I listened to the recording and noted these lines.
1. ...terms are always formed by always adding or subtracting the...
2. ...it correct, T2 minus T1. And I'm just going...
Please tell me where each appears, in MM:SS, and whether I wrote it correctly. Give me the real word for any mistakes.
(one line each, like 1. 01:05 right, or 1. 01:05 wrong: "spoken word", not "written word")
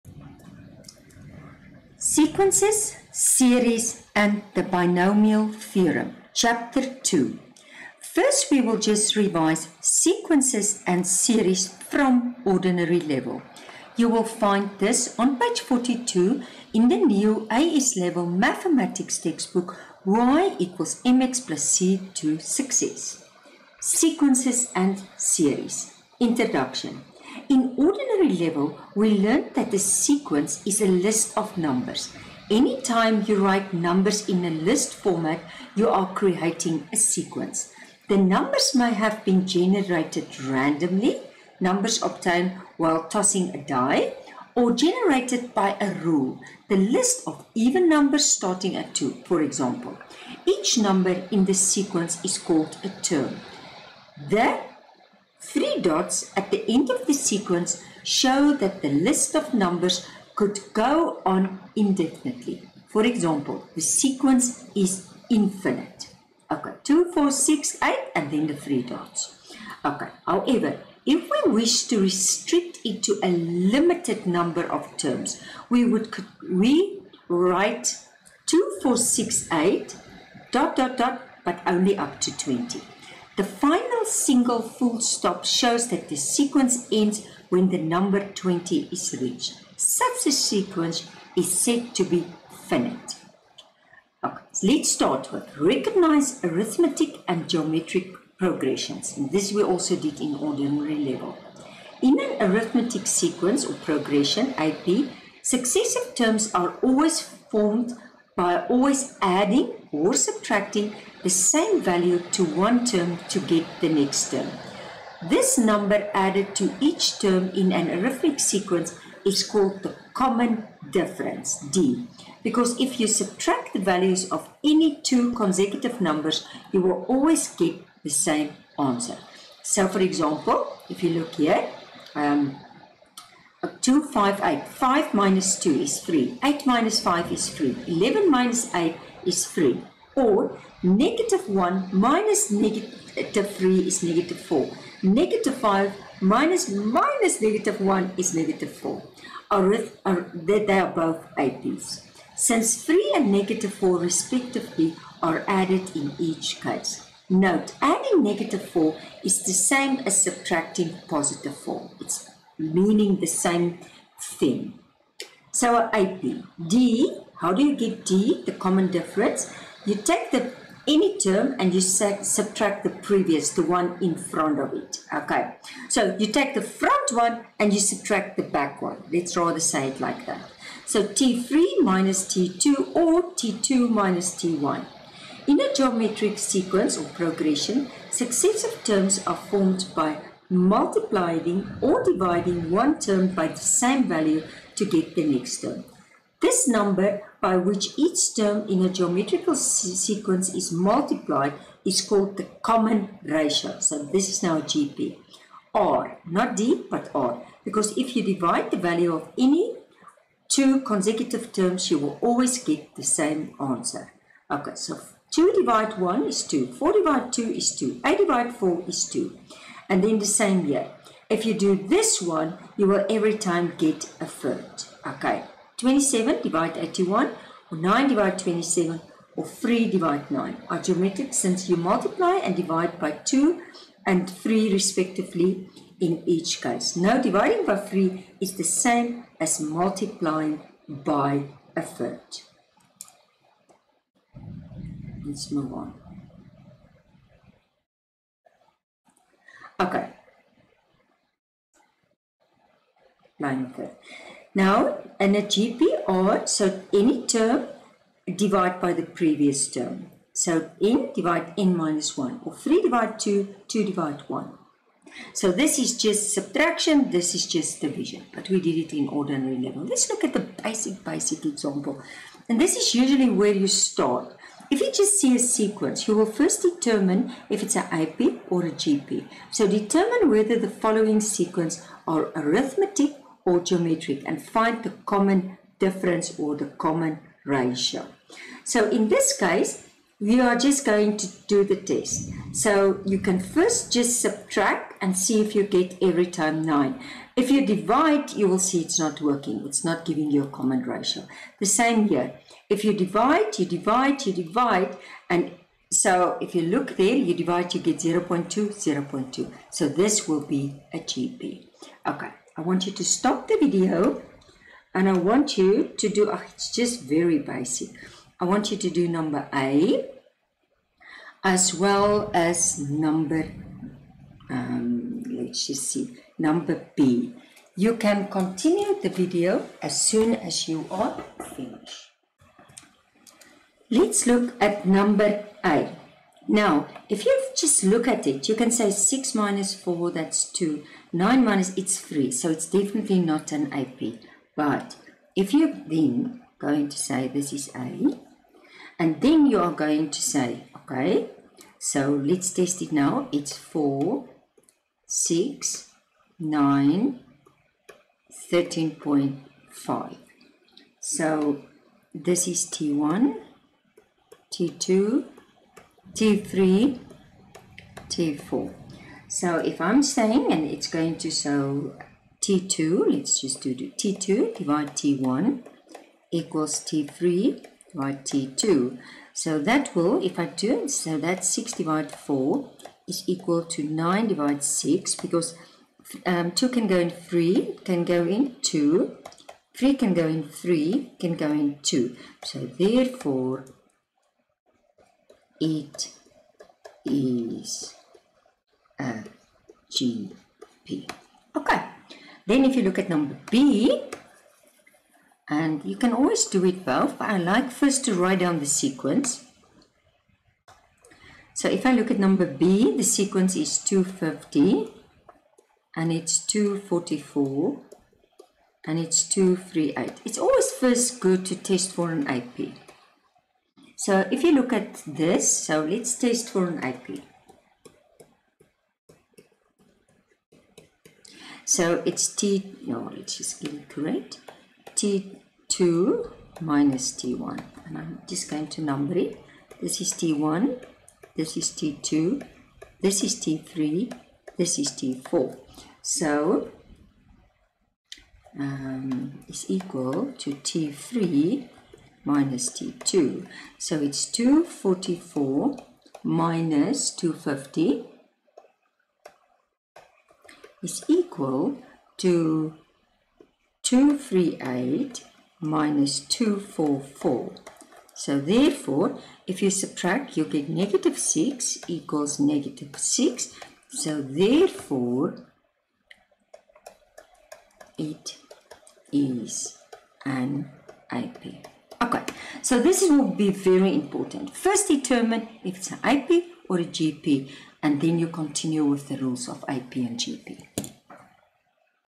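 1. 01:46 right
2. 07:13 right.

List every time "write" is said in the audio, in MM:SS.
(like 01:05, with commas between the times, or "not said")
00:33, 01:17, 06:48.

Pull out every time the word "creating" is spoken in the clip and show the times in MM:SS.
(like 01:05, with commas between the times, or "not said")
00:36.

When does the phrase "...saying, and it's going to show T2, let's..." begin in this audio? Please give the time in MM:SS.
06:10.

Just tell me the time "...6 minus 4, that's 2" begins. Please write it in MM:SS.
05:38.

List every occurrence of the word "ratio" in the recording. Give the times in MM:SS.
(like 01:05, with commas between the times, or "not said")
03:23, 04:47, 05:00.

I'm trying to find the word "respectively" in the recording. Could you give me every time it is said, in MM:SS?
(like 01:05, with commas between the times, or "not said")
02:33, 03:54.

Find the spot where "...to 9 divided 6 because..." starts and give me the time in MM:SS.
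06:23.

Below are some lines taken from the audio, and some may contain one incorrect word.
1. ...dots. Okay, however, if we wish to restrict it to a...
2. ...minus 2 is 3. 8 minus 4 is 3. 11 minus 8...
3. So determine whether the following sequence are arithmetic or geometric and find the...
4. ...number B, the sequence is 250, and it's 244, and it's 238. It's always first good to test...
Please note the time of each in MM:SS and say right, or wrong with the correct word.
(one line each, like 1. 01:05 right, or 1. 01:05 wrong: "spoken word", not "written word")
1. 01:08 right
2. 02:15 wrong: "5", not "4"
3. 04:39 right
4. 06:52 right.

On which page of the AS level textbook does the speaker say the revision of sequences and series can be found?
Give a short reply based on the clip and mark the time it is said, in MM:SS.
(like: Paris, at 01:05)
42, at 00:15.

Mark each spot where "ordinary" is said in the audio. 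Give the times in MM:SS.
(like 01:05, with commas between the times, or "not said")
00:12, 00:27, 01:40, 04:29.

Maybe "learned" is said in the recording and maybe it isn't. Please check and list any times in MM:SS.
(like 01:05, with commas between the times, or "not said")
00:29.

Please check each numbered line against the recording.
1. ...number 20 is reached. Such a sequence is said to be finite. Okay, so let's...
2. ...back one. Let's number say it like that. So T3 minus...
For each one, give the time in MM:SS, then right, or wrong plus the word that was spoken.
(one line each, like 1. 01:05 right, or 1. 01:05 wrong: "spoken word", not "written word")
1. 01:27 right
2. 02:58 wrong: "rather", not "number".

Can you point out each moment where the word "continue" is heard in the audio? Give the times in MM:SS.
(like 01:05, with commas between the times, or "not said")
05:28, 08:08.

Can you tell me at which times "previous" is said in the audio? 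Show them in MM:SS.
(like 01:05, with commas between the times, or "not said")
02:52, 04:19.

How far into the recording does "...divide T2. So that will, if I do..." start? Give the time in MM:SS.
06:17.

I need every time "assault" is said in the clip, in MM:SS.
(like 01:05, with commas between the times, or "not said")
not said.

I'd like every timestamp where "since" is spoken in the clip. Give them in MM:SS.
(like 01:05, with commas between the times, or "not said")
02:32, 03:51.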